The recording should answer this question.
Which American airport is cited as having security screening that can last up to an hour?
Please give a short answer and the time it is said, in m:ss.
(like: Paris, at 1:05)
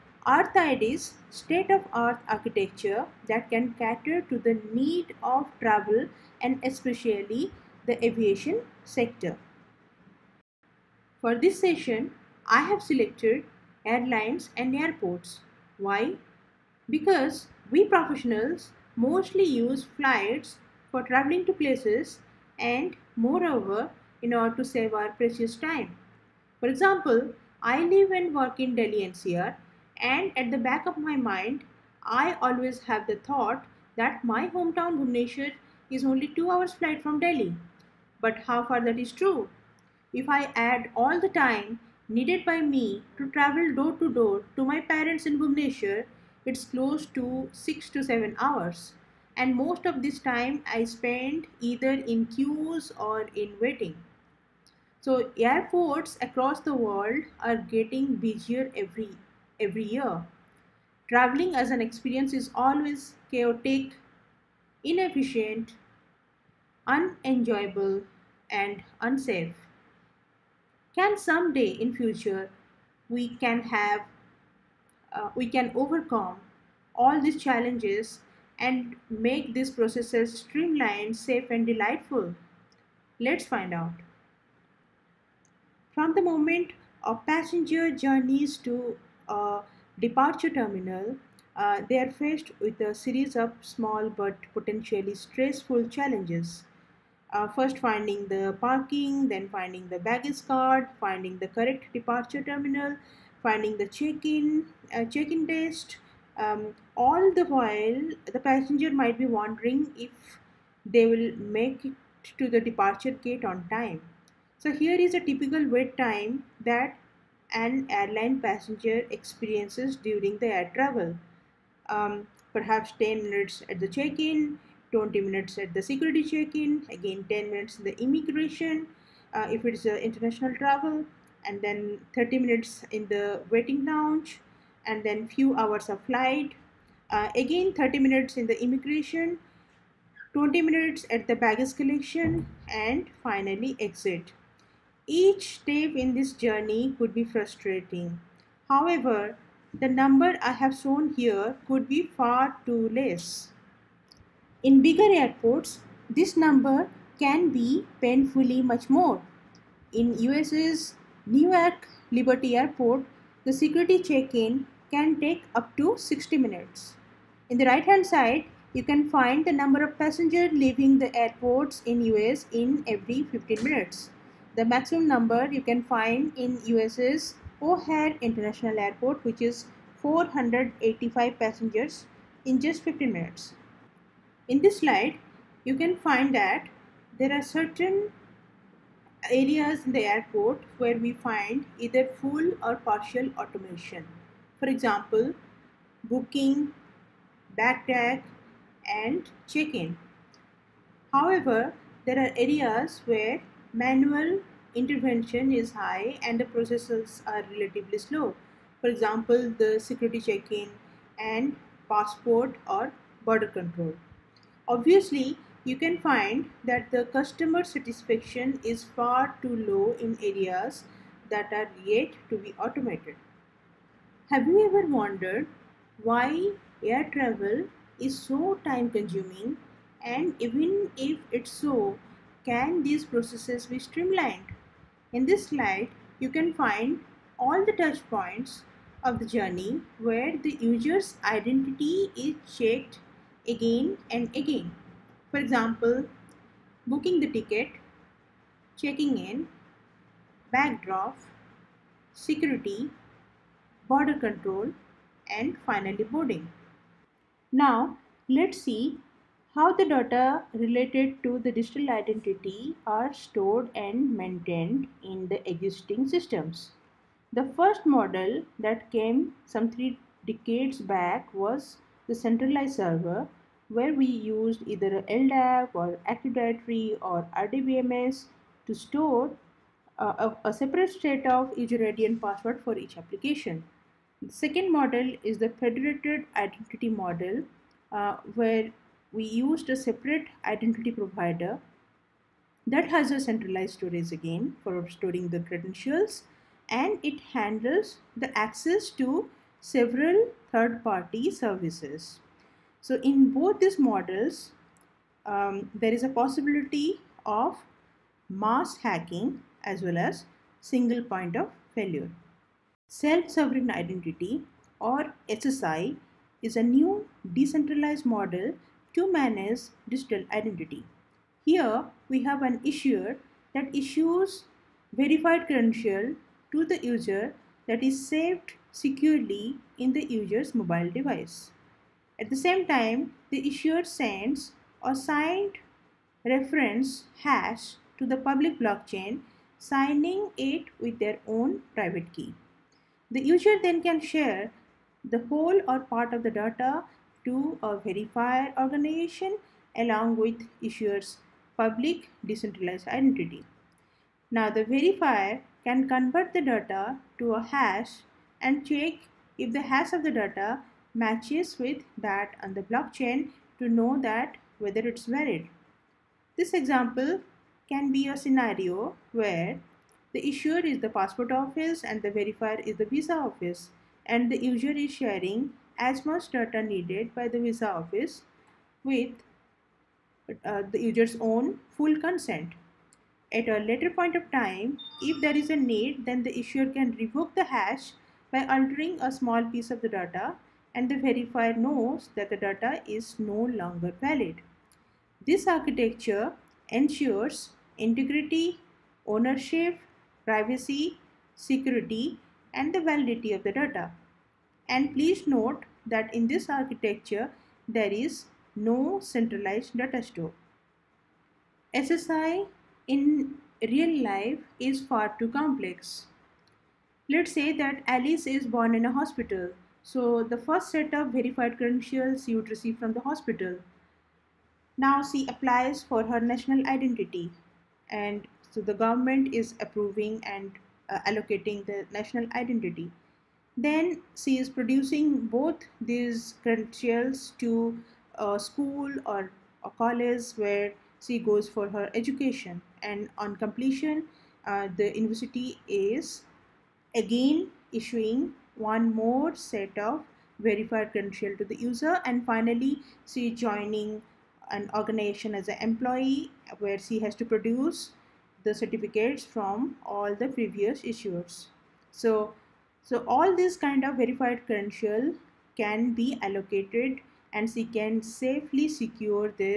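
Newark Liberty Airport, at 2:41.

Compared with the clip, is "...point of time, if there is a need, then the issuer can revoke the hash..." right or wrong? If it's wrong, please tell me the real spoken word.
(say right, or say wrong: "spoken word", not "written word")
right.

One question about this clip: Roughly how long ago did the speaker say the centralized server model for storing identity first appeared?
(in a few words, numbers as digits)
three decades.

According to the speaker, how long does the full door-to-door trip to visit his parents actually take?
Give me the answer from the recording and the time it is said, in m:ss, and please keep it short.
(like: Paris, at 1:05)
6 to 7 hours, at 0:47.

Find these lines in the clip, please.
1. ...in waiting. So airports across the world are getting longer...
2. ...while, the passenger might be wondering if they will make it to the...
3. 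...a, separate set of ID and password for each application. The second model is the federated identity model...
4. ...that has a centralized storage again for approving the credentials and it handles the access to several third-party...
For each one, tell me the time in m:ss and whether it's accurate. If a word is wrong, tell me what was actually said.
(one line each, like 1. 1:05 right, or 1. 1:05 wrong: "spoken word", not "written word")
1. 0:53 wrong: "busier", not "longer"
2. 1:47 right
3. 4:40 right
4. 4:52 wrong: "storing", not "approving".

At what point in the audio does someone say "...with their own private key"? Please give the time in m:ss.
5:40.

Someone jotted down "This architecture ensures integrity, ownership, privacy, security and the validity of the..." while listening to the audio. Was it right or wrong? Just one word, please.
right.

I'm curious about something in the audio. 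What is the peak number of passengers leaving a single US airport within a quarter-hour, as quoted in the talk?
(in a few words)
485.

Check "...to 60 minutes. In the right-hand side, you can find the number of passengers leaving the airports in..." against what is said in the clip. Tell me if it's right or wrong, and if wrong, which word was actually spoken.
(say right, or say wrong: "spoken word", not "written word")
right.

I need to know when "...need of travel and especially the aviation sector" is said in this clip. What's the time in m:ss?
0:04.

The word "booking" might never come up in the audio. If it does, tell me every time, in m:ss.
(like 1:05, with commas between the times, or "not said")
3:16, 4:06.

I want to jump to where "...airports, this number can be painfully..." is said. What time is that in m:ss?
2:35.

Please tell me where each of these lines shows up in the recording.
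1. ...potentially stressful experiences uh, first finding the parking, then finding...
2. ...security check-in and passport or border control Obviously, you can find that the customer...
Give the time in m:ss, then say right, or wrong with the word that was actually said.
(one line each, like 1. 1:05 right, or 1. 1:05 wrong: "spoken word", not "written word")
1. 1:34 wrong: "challenges", not "experiences"
2. 3:29 right.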